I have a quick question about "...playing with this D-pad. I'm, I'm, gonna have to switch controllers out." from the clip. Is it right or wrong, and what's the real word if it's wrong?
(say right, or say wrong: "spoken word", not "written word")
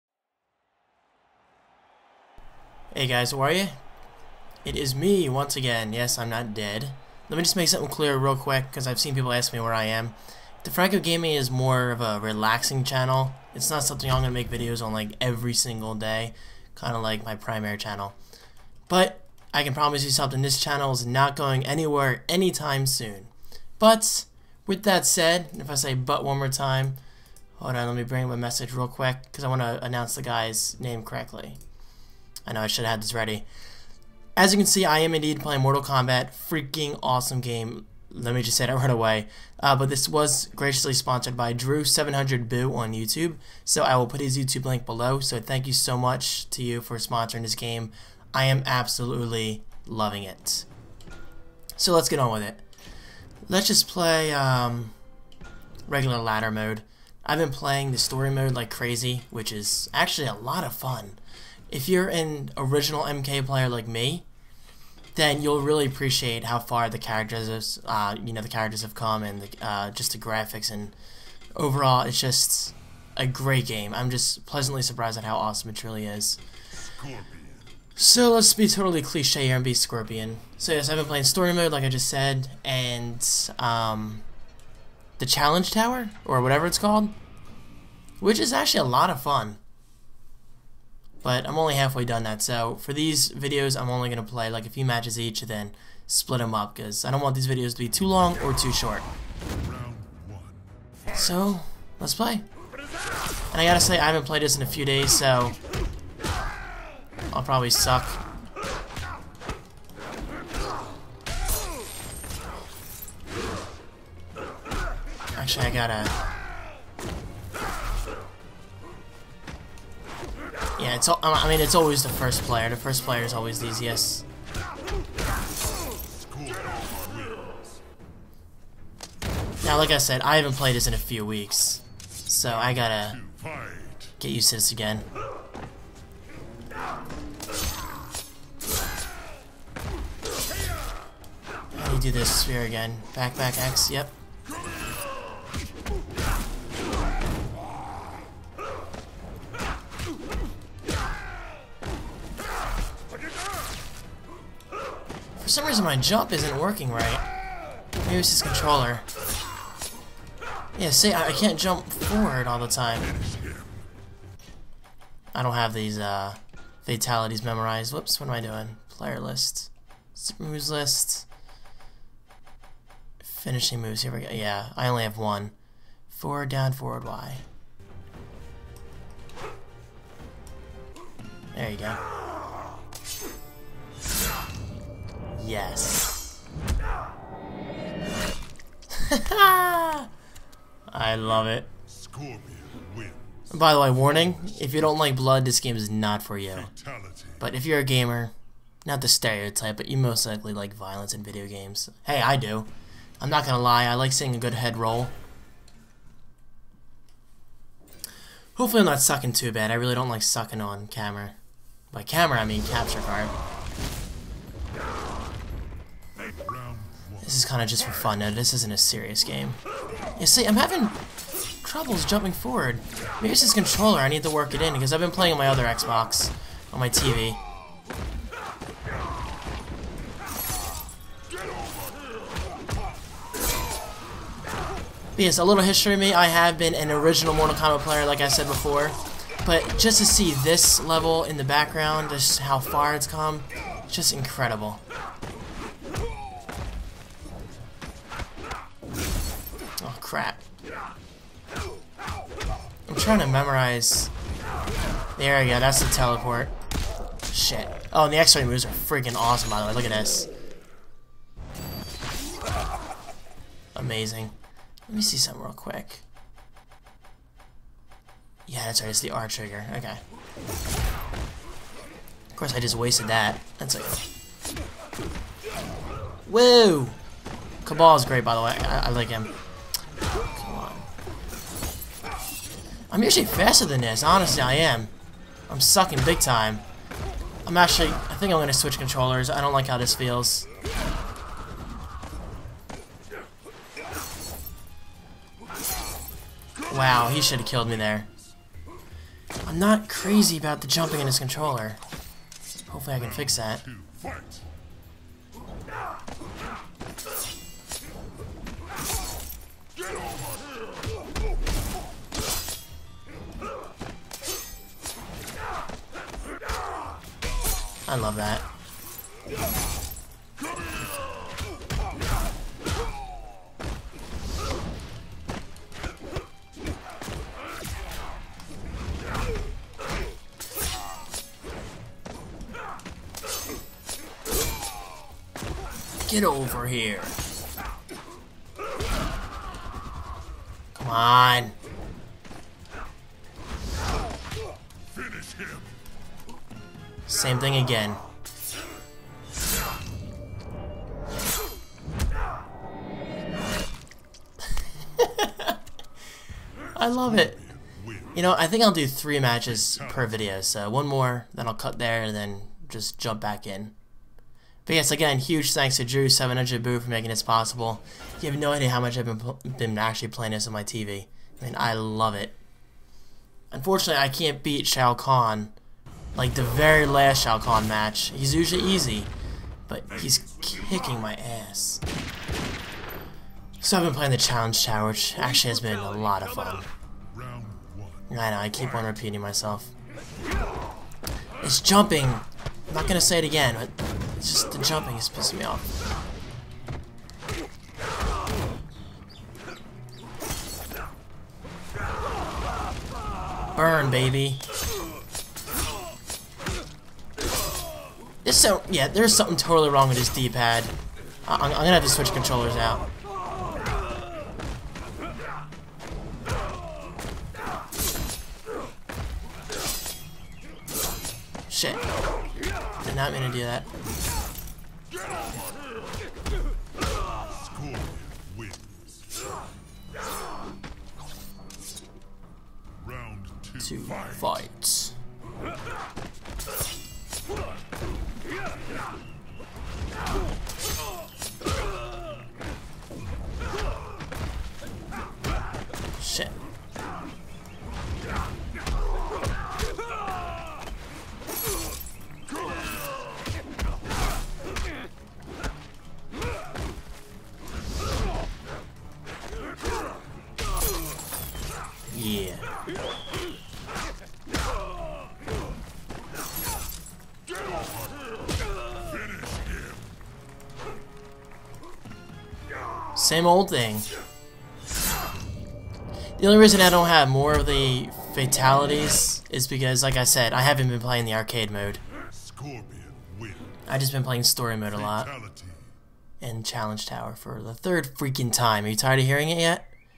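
wrong: "wrong", not "playing".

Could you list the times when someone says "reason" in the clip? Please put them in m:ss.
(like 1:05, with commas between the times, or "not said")
2:35, 7:56.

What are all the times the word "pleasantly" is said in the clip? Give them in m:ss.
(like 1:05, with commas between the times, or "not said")
1:14.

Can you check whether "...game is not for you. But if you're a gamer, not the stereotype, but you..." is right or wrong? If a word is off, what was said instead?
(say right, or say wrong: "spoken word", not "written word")
right.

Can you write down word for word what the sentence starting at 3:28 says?
Hopefully I'm not sucking too bad, I really don't like sucking on camera.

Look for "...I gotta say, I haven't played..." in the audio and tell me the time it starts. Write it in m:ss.
1:43.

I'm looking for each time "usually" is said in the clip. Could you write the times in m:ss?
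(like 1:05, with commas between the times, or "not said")
4:43, 6:18.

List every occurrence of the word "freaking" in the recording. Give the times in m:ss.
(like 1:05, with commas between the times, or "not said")
0:36, 4:18, 8:07.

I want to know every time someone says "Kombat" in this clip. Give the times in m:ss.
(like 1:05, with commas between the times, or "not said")
0:35, 3:57.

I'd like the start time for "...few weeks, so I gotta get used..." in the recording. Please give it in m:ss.
2:10.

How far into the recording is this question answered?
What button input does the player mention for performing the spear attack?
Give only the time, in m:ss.
2:23.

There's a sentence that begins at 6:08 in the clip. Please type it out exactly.
You have no idea how much I've been, been actually playing this on my TV.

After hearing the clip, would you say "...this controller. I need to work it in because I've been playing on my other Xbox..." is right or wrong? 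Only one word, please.
right.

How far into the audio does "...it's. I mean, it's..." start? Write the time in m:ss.
2:00.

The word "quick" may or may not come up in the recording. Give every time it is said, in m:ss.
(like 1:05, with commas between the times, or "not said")
0:08, 0:28, 4:25.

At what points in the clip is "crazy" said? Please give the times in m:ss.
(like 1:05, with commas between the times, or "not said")
0:58, 4:59.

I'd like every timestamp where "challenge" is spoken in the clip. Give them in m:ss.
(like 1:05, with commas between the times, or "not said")
1:25, 6:24, 8:06.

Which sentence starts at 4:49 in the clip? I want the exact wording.
I don't like how this feels.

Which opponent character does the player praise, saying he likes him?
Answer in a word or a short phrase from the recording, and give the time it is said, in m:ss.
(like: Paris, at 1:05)
Kabal, at 4:37.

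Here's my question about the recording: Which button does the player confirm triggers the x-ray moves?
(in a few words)
R trigger.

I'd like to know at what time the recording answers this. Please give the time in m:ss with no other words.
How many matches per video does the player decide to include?
5:58.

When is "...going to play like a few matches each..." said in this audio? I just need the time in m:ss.
1:34.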